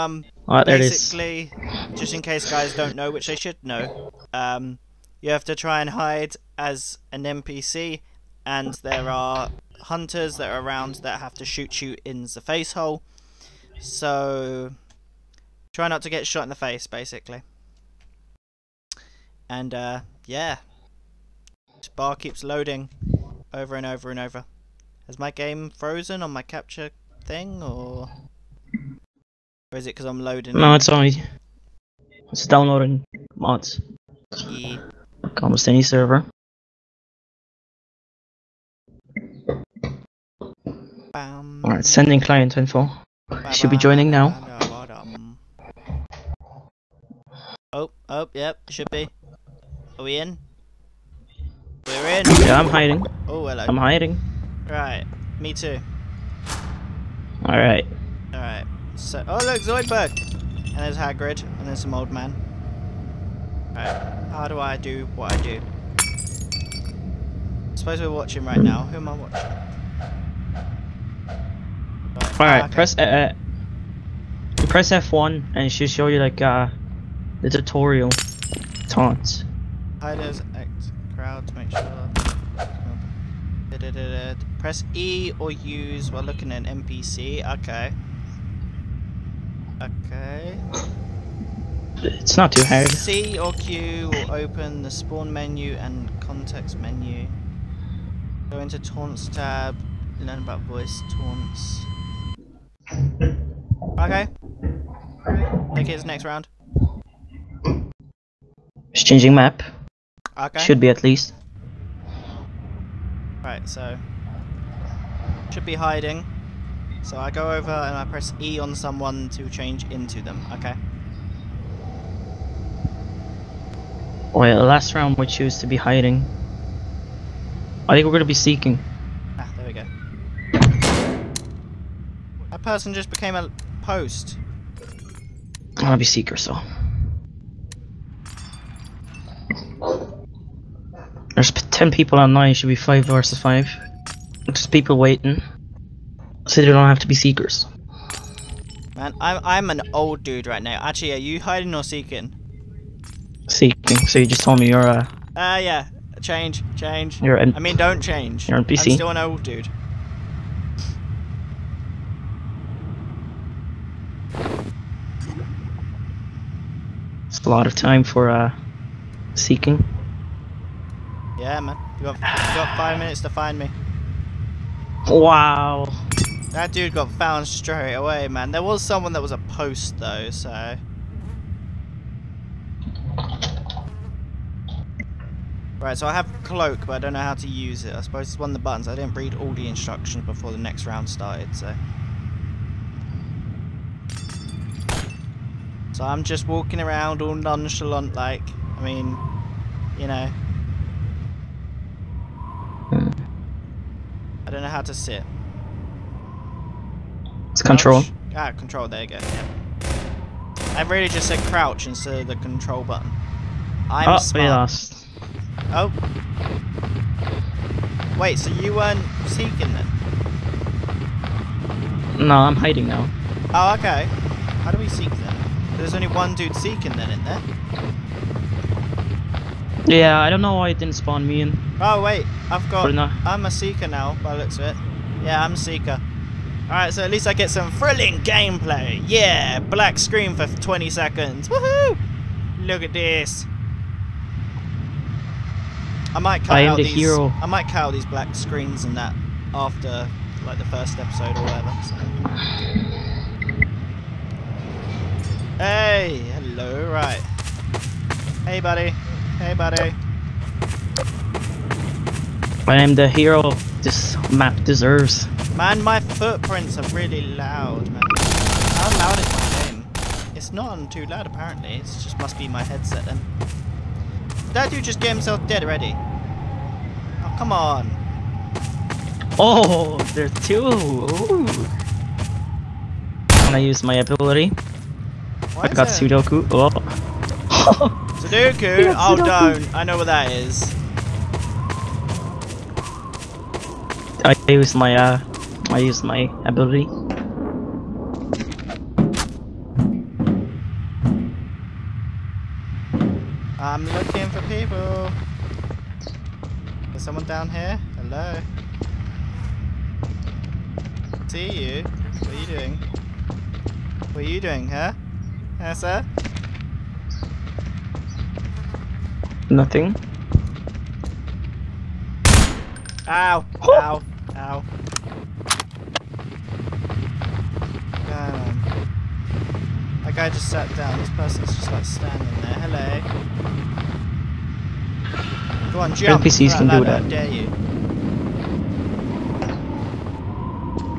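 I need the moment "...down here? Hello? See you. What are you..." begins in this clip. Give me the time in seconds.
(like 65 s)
307 s.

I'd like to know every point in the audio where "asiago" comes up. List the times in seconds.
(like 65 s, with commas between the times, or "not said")
not said.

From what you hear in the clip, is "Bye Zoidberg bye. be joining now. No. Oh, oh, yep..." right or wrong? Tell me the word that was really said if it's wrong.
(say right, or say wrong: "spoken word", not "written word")
wrong: "Should", not "Zoidberg".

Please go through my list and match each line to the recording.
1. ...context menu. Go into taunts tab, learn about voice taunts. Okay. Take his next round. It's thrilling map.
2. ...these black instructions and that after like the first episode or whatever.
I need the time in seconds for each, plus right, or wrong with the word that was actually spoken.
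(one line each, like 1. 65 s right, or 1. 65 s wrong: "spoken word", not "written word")
1. 96 s wrong: "changing", not "thrilling"
2. 247 s wrong: "screens", not "instructions".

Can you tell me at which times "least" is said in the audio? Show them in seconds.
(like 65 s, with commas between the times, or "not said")
111 s, 237 s.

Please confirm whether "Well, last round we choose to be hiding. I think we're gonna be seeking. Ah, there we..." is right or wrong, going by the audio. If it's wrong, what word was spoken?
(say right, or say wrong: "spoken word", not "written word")
right.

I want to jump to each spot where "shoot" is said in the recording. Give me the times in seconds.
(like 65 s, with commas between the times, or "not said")
11 s.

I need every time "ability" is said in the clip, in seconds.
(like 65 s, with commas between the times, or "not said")
283 s, 296 s.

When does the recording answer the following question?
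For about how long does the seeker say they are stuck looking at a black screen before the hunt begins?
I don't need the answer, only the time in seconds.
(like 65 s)
240 s.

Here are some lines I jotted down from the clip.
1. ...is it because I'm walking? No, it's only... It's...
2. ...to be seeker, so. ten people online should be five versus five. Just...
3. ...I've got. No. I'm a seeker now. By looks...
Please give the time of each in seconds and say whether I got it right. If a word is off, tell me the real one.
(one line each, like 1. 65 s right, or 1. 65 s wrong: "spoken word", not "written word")
1. 29 s wrong: "loading", not "walking"
2. 135 s right
3. 232 s right.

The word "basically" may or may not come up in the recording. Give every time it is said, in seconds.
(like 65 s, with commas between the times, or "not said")
0 s, 16 s.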